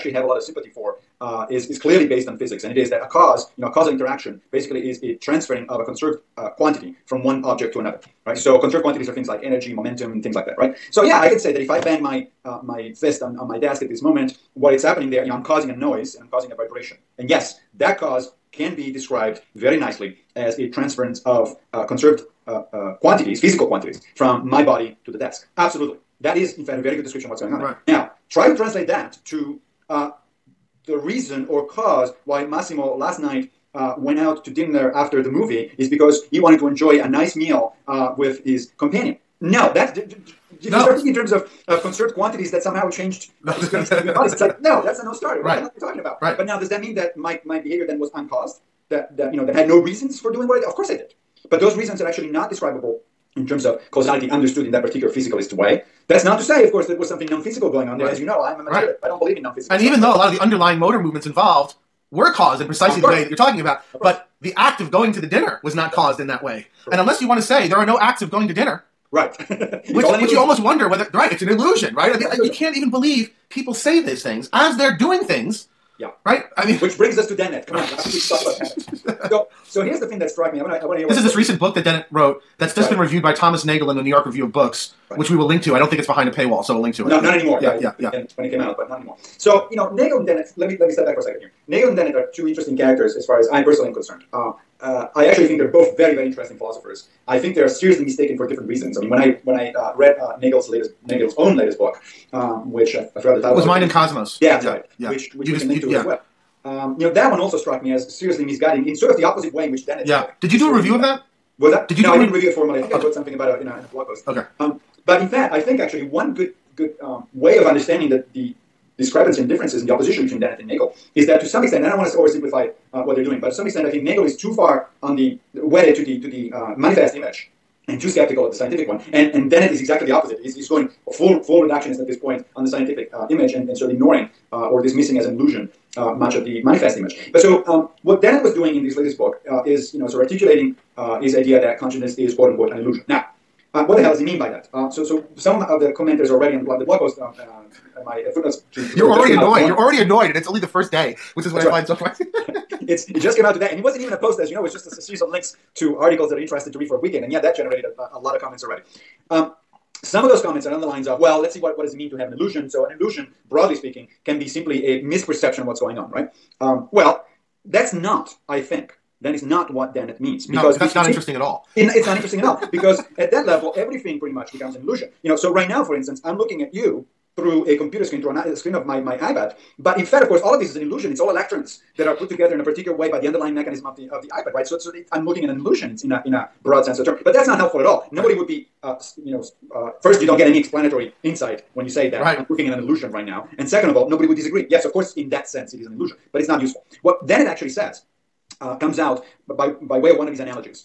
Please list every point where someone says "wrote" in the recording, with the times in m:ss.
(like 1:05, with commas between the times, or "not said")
1:22, 1:53.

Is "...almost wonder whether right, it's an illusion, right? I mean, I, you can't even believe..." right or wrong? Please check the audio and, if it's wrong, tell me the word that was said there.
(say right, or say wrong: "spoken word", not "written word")
right.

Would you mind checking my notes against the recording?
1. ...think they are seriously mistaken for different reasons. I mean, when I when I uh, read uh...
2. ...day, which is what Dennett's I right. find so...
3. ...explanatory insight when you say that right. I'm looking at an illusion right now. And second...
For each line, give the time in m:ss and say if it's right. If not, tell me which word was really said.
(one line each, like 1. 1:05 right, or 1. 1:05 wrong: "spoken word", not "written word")
1. 1:37 right
2. 2:30 wrong: "That", not "Dennett"
3. 3:10 right.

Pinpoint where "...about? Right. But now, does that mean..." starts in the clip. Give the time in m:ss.
0:45.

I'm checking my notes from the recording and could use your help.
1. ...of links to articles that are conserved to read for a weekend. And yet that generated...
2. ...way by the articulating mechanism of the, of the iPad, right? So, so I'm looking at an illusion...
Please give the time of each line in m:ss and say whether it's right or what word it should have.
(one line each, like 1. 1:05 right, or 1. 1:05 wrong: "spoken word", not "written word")
1. 2:35 wrong: "interested", not "conserved"
2. 3:02 wrong: "underlying", not "articulating".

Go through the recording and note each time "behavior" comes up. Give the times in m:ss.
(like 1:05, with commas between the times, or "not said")
0:47.